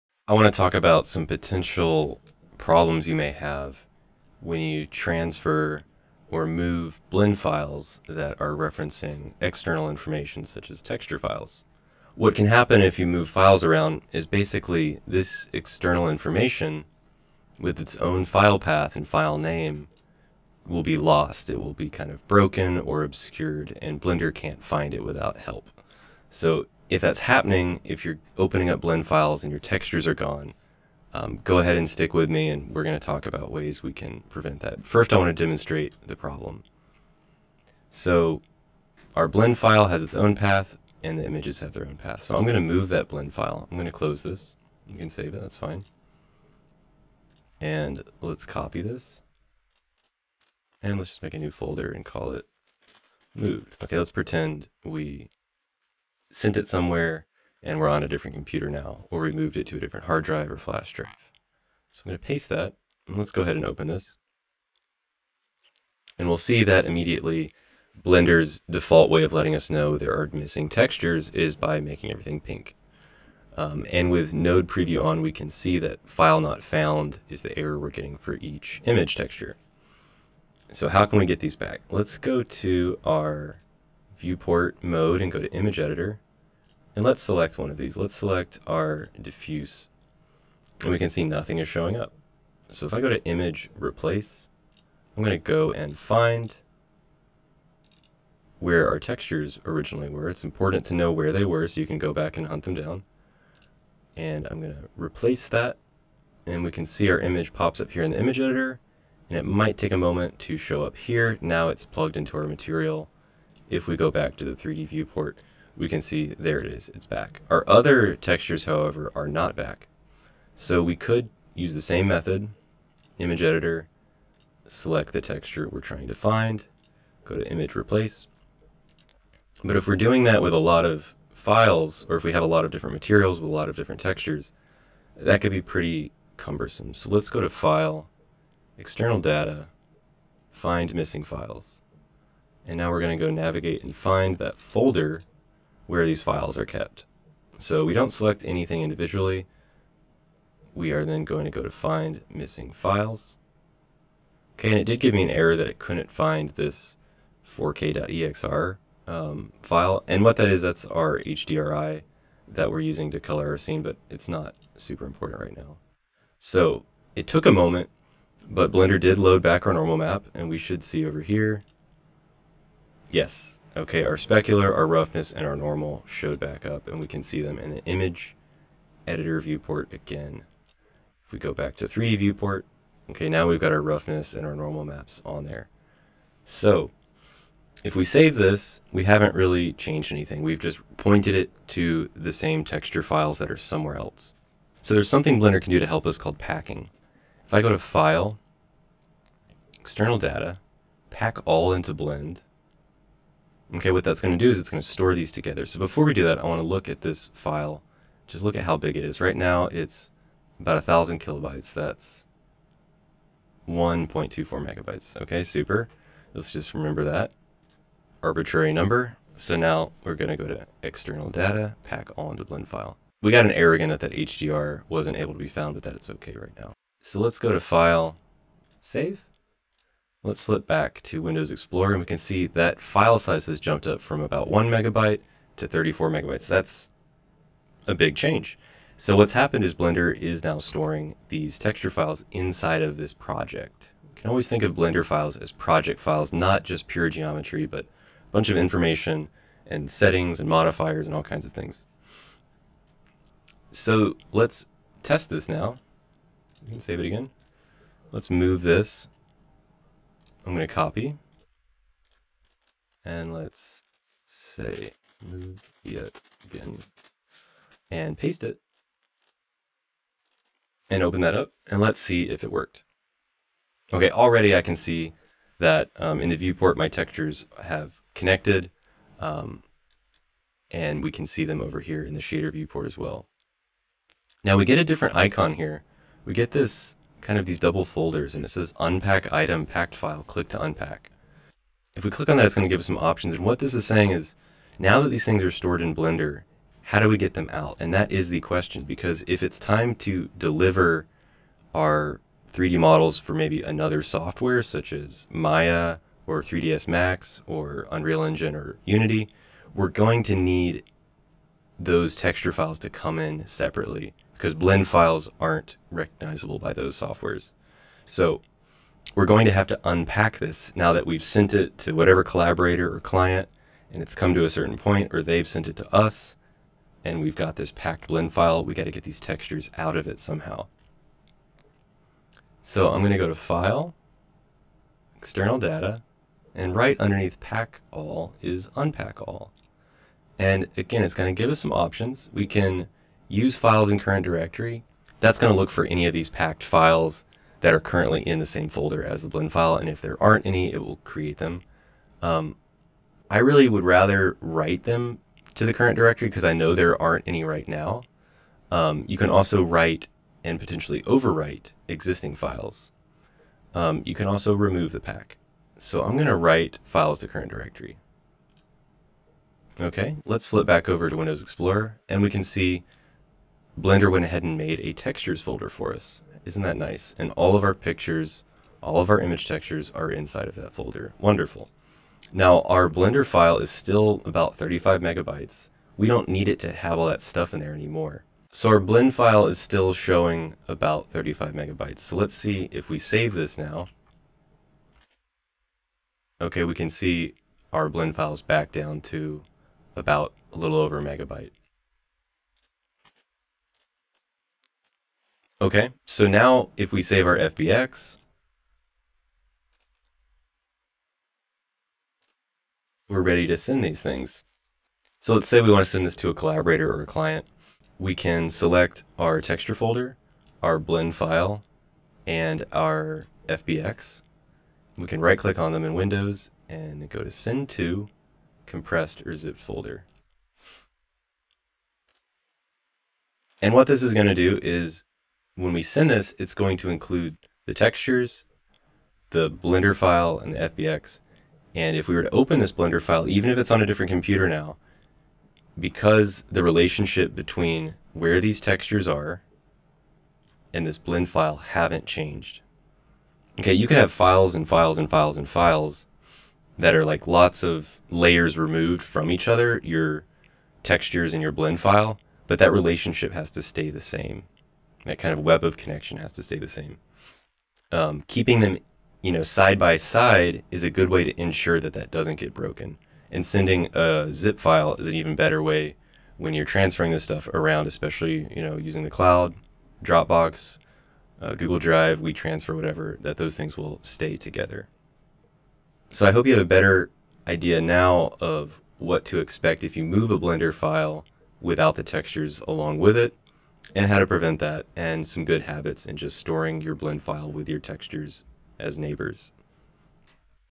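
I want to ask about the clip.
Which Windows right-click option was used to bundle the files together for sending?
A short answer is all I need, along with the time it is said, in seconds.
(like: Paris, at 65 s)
compressed or zipped folder, at 428 s.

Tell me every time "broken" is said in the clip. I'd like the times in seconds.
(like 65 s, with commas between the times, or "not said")
22 s, 472 s.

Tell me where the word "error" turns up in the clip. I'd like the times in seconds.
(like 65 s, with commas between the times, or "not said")
77 s, 155 s, 223 s.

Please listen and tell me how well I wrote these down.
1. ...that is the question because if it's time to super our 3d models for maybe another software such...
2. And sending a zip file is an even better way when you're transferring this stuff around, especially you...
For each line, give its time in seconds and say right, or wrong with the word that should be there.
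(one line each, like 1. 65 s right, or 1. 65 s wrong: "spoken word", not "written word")
1. 297 s wrong: "deliver", not "super"
2. 473 s right.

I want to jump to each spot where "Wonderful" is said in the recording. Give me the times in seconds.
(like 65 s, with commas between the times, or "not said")
381 s.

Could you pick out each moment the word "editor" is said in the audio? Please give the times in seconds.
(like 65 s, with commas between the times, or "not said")
85 s, 108 s, 123 s, 179 s.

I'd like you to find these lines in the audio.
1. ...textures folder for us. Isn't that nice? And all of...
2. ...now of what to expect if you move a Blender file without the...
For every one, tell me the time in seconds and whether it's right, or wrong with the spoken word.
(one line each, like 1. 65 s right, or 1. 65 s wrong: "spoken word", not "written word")
1. 374 s right
2. 487 s right.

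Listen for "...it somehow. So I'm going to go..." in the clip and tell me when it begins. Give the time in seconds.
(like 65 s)
330 s.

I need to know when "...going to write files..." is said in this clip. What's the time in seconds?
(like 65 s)
366 s.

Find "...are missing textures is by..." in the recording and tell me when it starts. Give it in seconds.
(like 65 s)
70 s.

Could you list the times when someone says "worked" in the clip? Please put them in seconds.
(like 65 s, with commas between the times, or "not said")
272 s.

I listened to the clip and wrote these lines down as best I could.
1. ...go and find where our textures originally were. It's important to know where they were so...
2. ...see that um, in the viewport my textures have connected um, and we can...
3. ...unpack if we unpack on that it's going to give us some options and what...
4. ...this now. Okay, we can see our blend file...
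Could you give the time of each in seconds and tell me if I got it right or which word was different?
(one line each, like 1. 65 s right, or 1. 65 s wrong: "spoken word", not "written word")
1. 95 s right
2. 274 s right
3. 290 s wrong: "click", not "unpack"
4. 393 s right.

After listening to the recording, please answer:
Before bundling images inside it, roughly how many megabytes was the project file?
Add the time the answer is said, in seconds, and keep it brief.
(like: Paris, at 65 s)
1.24 megabytes, at 213 s.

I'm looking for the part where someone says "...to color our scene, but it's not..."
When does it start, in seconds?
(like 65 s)
163 s.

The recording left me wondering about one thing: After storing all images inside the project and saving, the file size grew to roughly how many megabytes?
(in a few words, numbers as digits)
34 megabytes.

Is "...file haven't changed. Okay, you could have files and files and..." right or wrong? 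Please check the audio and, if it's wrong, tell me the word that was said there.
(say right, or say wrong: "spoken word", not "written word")
right.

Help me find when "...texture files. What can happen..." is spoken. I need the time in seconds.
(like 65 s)
10 s.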